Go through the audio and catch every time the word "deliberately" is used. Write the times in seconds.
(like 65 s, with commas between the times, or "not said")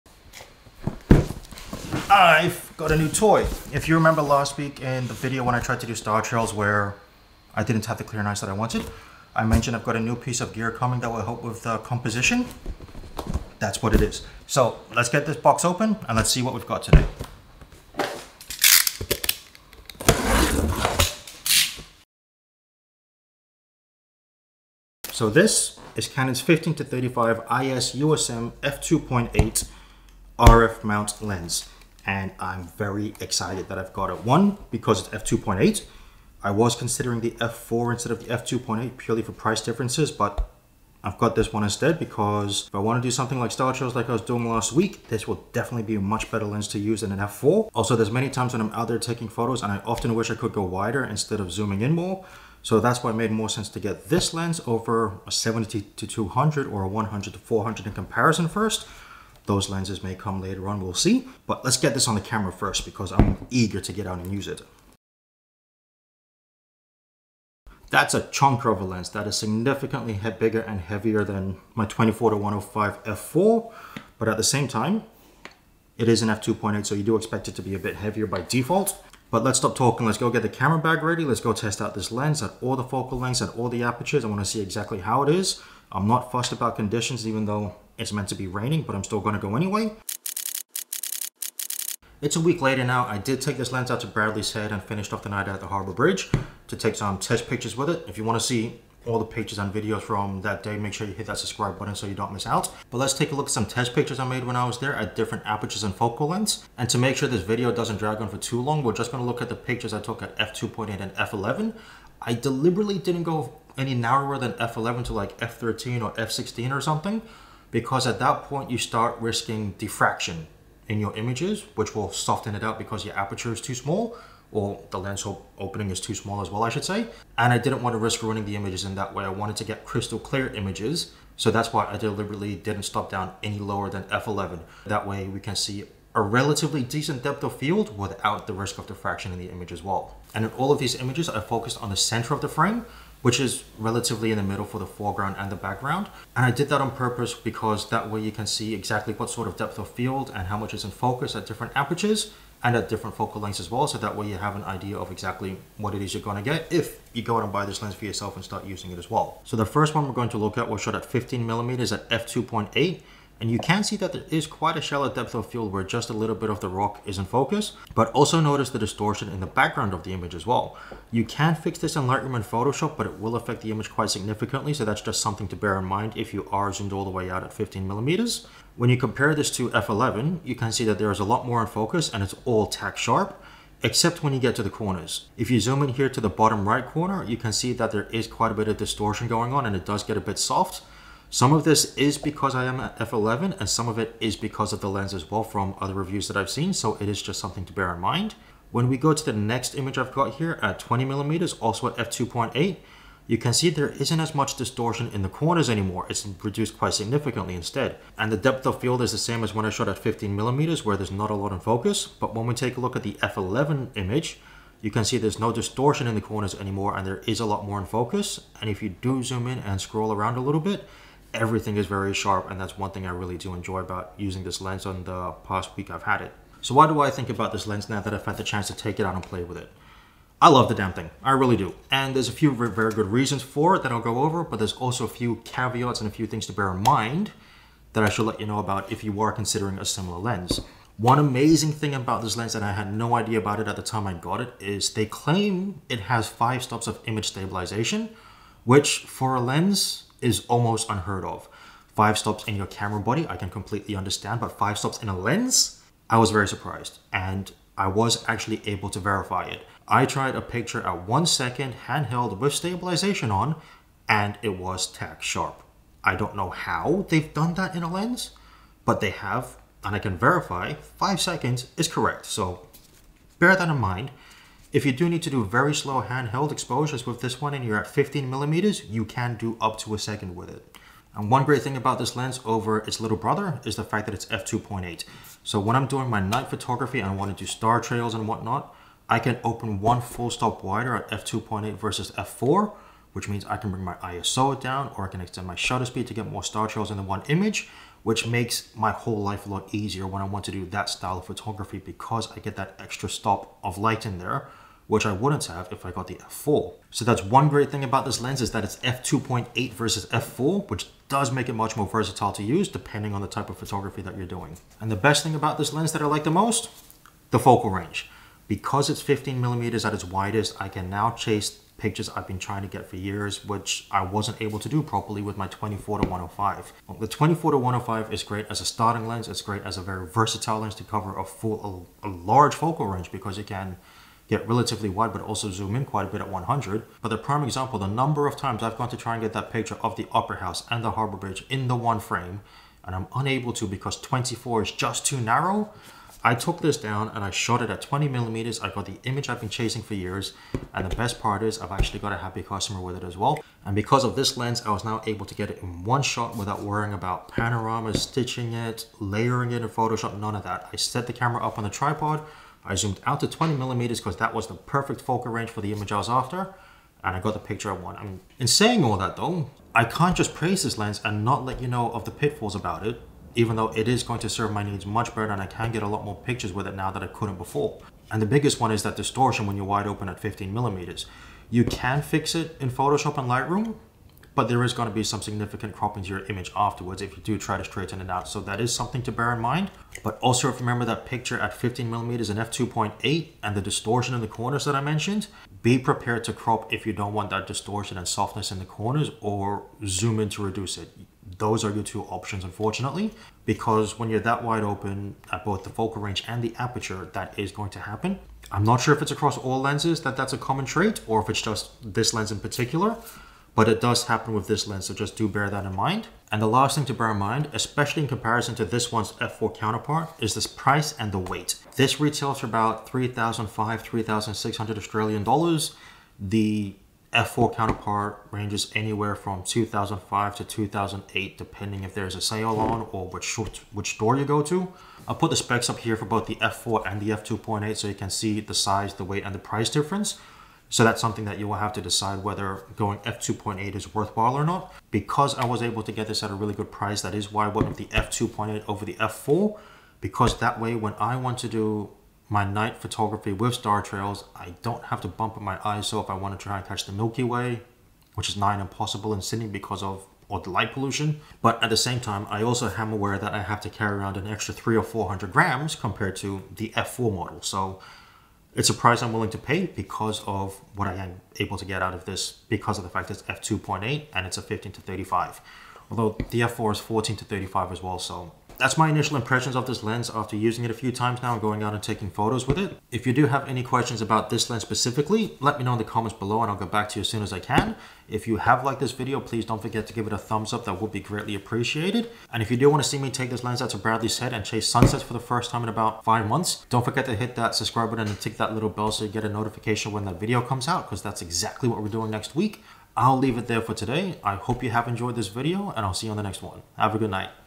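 112 s, 131 s.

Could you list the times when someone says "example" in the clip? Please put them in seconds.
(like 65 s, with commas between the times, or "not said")
337 s.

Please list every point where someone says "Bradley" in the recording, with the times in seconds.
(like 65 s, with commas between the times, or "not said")
94 s, 493 s.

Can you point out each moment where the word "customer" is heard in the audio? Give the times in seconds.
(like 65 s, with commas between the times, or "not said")
352 s.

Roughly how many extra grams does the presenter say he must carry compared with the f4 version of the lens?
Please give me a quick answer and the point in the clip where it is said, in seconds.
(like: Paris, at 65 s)
300 or 400 grams, at 464 s.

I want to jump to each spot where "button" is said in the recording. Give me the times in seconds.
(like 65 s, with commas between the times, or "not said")
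101 s, 497 s.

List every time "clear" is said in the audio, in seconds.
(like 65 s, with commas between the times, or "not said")
8 s, 130 s.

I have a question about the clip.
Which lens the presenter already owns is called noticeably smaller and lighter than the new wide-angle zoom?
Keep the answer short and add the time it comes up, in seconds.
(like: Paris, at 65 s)
24 to 105 f4, at 71 s.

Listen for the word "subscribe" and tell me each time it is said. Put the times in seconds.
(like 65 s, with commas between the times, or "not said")
101 s, 497 s.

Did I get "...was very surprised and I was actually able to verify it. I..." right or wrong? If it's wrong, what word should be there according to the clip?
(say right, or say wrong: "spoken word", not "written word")
right.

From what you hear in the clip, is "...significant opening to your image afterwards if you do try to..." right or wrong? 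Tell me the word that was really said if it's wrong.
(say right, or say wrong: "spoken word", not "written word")
wrong: "cropping", not "opening".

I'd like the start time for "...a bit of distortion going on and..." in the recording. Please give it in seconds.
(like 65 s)
188 s.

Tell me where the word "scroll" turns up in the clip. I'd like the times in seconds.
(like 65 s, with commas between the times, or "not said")
219 s.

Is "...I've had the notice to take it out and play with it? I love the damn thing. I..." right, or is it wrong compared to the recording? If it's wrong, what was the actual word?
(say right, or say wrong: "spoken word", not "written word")
wrong: "chance", not "notice".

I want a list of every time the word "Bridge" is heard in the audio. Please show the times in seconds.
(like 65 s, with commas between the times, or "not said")
95 s, 341 s.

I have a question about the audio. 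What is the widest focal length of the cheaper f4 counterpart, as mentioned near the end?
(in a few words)
14 millimeters.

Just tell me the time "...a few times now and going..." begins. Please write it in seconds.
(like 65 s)
480 s.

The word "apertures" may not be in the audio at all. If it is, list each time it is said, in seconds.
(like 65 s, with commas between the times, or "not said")
83 s, 105 s, 123 s, 151 s, 406 s.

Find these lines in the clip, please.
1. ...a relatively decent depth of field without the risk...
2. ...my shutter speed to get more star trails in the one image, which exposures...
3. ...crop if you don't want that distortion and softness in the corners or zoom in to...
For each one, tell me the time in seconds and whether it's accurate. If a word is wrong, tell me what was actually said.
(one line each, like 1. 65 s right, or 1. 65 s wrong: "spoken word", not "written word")
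1. 136 s right
2. 295 s wrong: "makes", not "exposures"
3. 396 s right.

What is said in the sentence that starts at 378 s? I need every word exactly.
And the biggest one is that distortion when you're wide open at 15 millimeters.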